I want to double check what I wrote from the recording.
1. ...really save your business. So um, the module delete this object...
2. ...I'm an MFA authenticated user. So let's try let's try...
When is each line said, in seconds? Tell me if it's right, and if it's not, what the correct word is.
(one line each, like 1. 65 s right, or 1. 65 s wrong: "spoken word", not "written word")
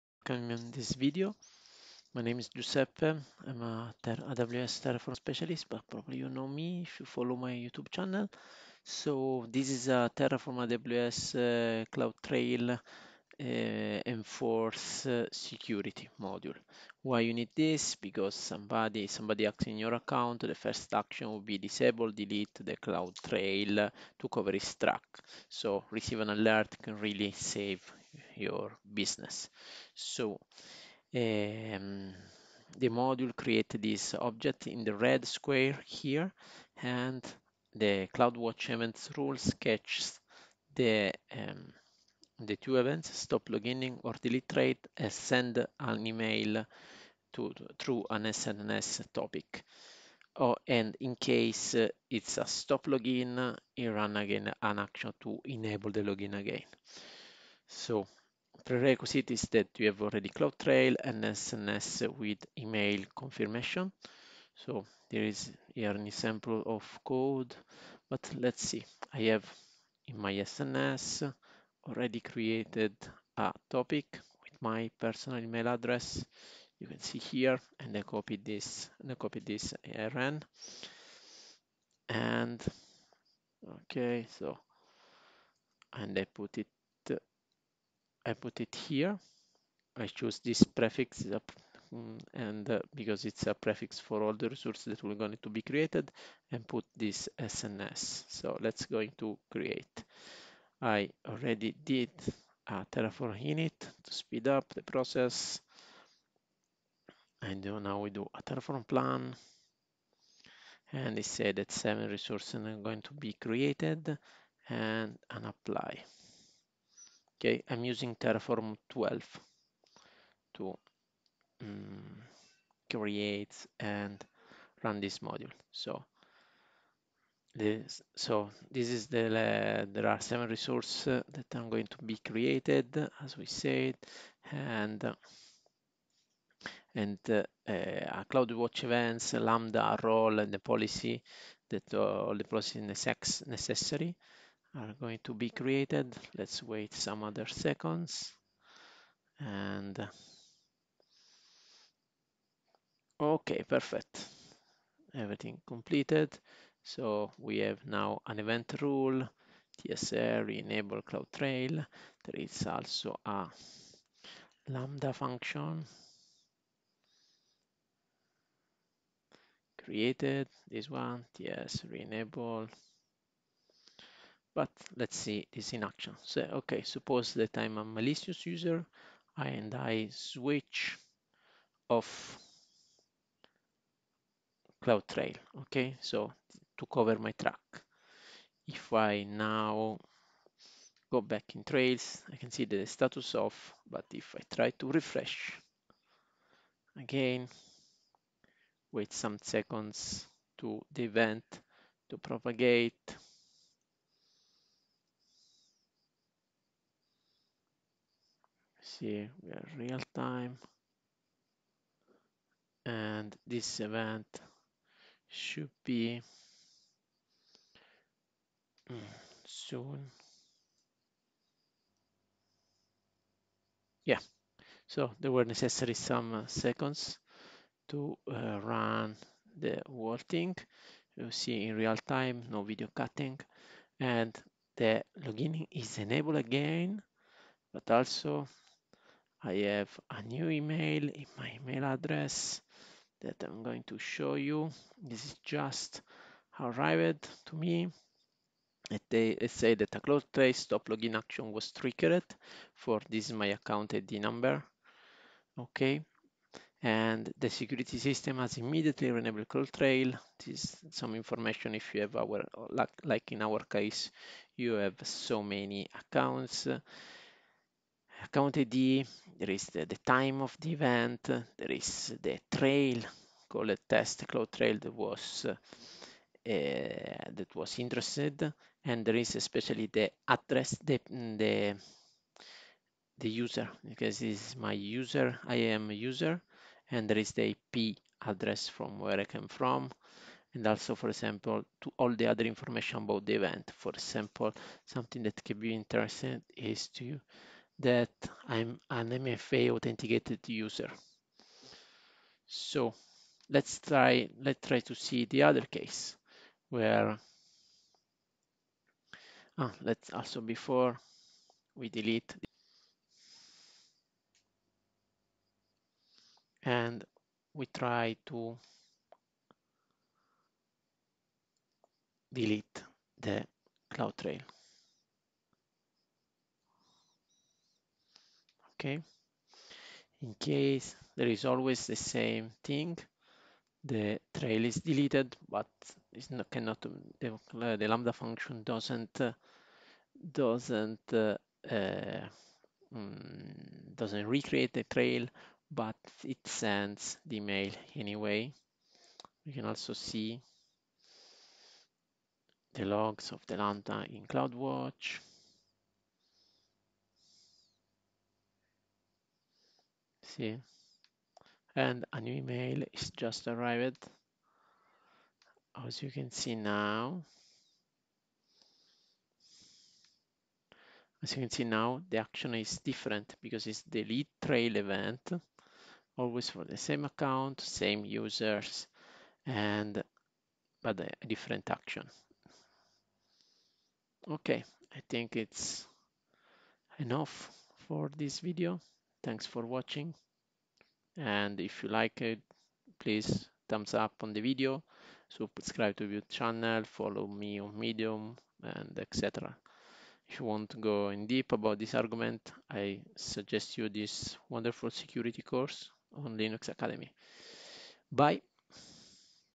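1. 26 s wrong: "create", not "delete"
2. 298 s right.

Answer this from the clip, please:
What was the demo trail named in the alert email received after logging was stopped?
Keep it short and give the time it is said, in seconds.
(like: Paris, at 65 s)
test cloud trail, at 273 s.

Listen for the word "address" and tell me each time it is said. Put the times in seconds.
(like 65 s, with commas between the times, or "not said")
75 s, 241 s, 280 s, 288 s.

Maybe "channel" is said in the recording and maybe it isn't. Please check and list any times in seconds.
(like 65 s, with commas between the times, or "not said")
7 s, 396 s.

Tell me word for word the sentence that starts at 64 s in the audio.
So there is here an example of code, but let's see.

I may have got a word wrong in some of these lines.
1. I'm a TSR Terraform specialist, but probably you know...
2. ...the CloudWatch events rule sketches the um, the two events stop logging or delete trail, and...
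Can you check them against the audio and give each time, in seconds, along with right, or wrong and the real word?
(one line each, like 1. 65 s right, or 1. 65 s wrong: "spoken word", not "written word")
1. 3 s wrong: "AWS", not "TSR"
2. 37 s right.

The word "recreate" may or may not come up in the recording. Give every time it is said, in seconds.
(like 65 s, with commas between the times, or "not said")
344 s.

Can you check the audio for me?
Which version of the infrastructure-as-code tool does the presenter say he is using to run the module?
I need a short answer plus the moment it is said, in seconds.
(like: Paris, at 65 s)
Terraform 12, at 118 s.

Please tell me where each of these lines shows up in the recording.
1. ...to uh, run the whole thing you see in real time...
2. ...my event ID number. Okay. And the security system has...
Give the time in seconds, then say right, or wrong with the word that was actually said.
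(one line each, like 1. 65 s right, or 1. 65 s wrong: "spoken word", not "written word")
1. 227 s right
2. 253 s wrong: "account", not "event".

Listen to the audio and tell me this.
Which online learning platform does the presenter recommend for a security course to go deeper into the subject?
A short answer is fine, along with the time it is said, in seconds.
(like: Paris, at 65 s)
Linux Academy, at 406 s.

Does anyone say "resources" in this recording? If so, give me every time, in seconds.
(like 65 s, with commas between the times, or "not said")
94 s, 112 s, 130 s.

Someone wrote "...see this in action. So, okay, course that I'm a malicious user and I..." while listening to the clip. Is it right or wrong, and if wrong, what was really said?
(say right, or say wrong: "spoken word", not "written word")
wrong: "suppose", not "course".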